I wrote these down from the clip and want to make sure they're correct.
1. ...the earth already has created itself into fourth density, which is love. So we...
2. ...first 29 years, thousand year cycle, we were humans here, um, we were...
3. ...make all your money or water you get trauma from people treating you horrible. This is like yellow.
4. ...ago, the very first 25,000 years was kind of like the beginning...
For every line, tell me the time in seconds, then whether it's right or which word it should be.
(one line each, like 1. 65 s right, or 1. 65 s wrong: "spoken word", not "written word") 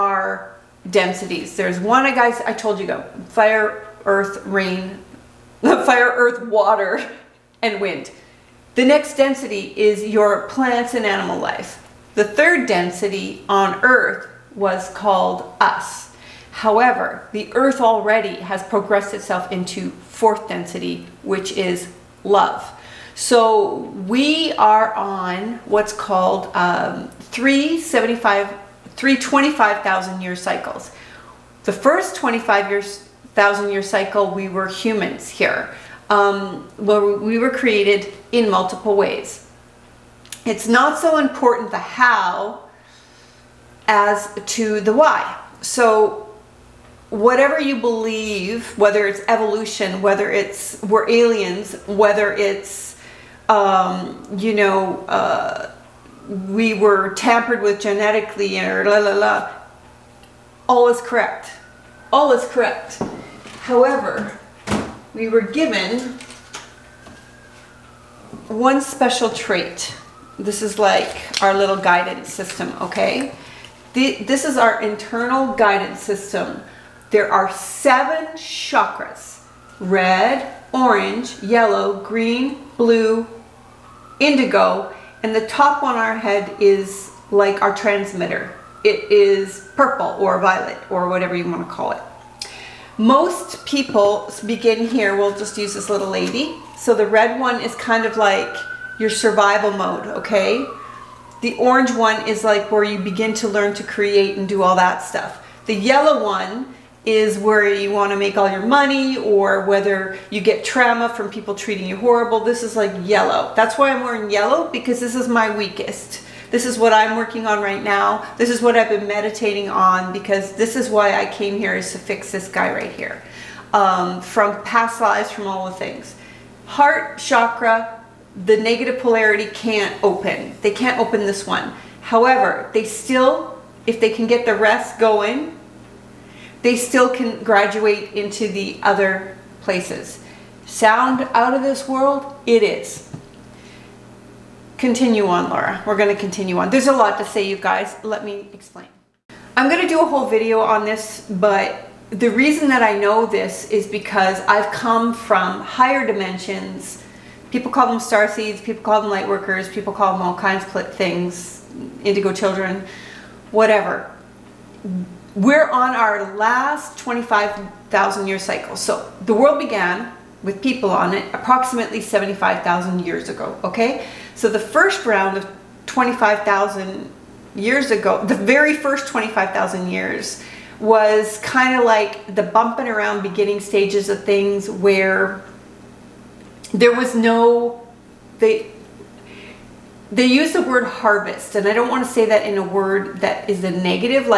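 1. 17 s wrong: "progressed", not "created"
2. 31 s wrong: "25", not "29"
3. 108 s wrong: "whether", not "water"
4. 177 s wrong: "bumping", not "beginning".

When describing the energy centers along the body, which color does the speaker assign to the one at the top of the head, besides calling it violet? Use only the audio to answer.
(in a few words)
Purple.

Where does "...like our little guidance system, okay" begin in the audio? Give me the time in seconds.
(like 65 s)
70 s.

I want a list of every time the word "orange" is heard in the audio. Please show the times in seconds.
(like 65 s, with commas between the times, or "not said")
80 s, 101 s.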